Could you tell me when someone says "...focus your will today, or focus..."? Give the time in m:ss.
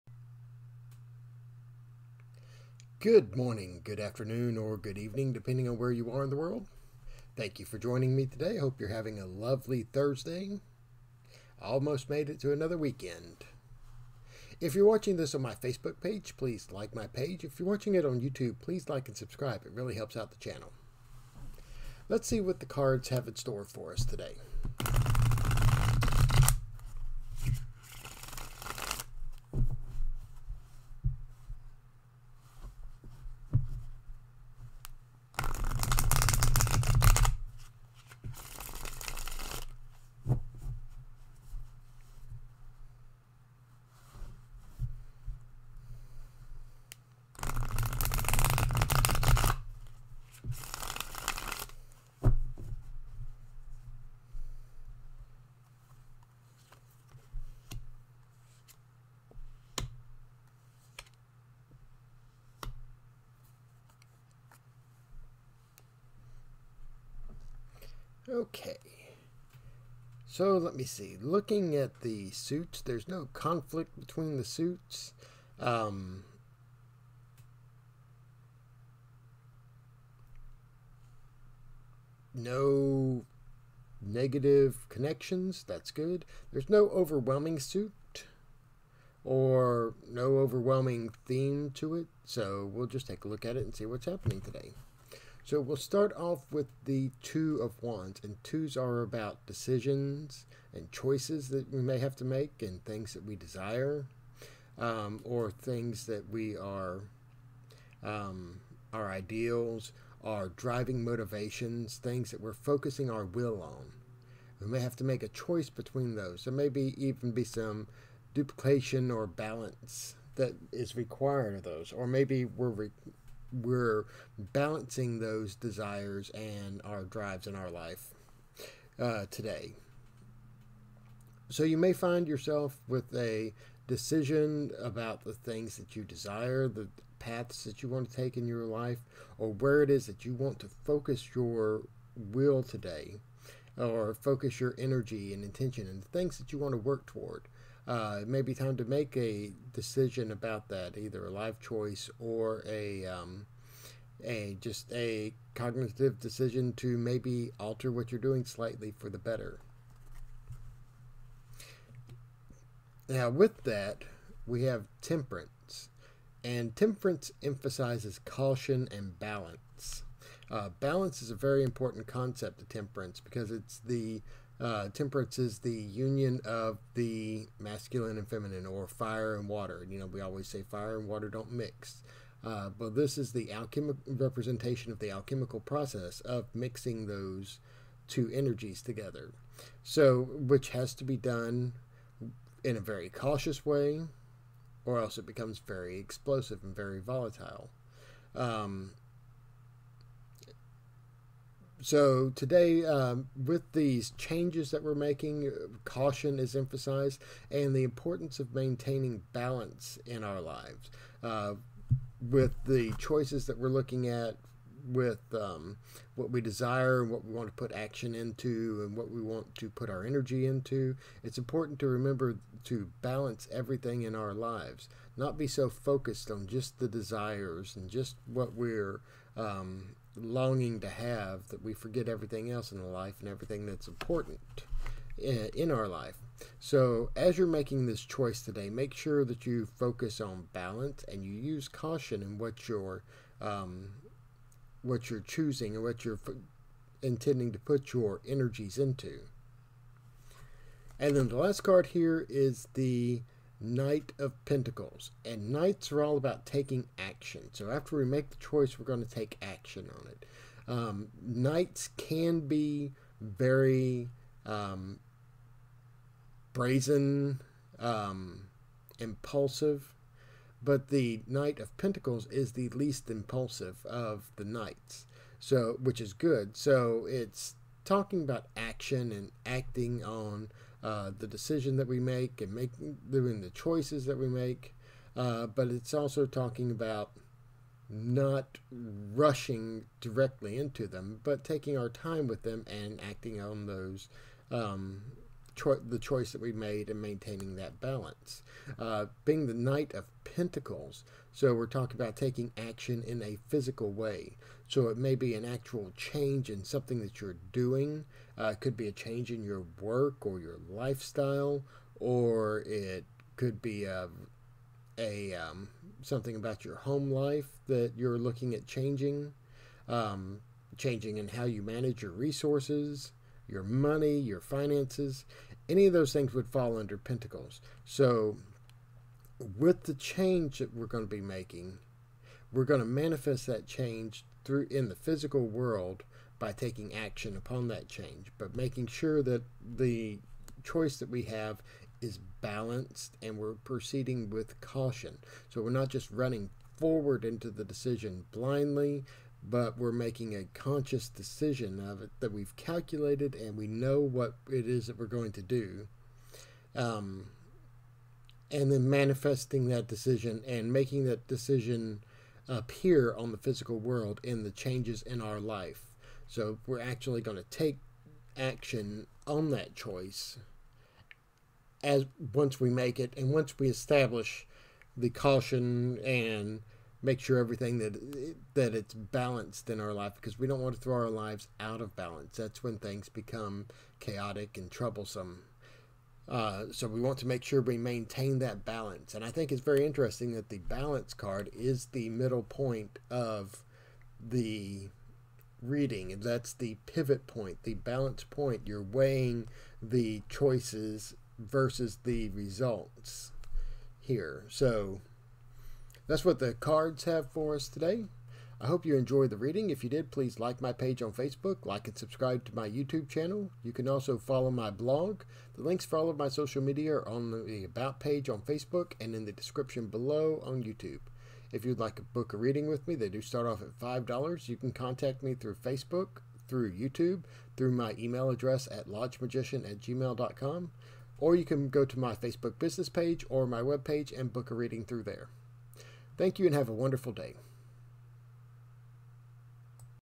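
2:20.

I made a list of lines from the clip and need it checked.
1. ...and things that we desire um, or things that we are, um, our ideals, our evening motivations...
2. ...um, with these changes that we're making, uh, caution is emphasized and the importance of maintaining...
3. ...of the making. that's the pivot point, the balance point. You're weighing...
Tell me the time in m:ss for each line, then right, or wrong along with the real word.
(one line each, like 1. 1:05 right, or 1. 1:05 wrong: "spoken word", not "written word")
1. 1:42 wrong: "driving", not "evening"
2. 3:22 right
3. 6:33 wrong: "reading", not "making".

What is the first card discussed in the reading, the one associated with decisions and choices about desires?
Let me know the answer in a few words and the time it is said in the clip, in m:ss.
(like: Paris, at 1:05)
Two of Wands, at 1:37.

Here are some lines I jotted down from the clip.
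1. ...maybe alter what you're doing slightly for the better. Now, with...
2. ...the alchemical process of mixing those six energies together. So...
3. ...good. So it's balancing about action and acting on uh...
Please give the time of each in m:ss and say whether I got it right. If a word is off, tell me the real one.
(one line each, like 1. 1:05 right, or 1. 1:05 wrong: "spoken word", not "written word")
1. 2:36 right
2. 3:04 wrong: "two", not "six"
3. 4:36 wrong: "talking", not "balancing".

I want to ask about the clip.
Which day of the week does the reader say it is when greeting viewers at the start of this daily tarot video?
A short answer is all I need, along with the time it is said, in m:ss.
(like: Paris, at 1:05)
Thursday, at 0:09.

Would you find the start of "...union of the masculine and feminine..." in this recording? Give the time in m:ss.
2:55.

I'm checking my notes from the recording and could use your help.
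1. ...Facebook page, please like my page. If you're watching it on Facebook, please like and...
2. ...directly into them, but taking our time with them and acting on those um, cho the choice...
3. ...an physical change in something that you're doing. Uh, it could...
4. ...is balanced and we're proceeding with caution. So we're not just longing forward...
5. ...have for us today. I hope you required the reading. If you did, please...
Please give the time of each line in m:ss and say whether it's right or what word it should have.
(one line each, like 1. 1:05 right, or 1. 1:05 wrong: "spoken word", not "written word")
1. 0:15 wrong: "YouTube", not "Facebook"
2. 4:49 right
3. 5:05 wrong: "actual", not "physical"
4. 5:42 wrong: "running", not "longing"
5. 6:47 wrong: "enjoyed", not "required".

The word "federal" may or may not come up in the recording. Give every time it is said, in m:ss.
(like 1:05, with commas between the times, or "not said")
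not said.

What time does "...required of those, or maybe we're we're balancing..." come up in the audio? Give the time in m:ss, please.
2:00.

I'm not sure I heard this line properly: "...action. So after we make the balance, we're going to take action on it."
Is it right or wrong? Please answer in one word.
wrong.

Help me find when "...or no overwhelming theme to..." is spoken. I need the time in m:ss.
1:29.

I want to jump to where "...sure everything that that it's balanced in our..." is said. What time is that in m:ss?
6:17.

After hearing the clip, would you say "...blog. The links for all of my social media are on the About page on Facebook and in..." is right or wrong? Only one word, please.
right.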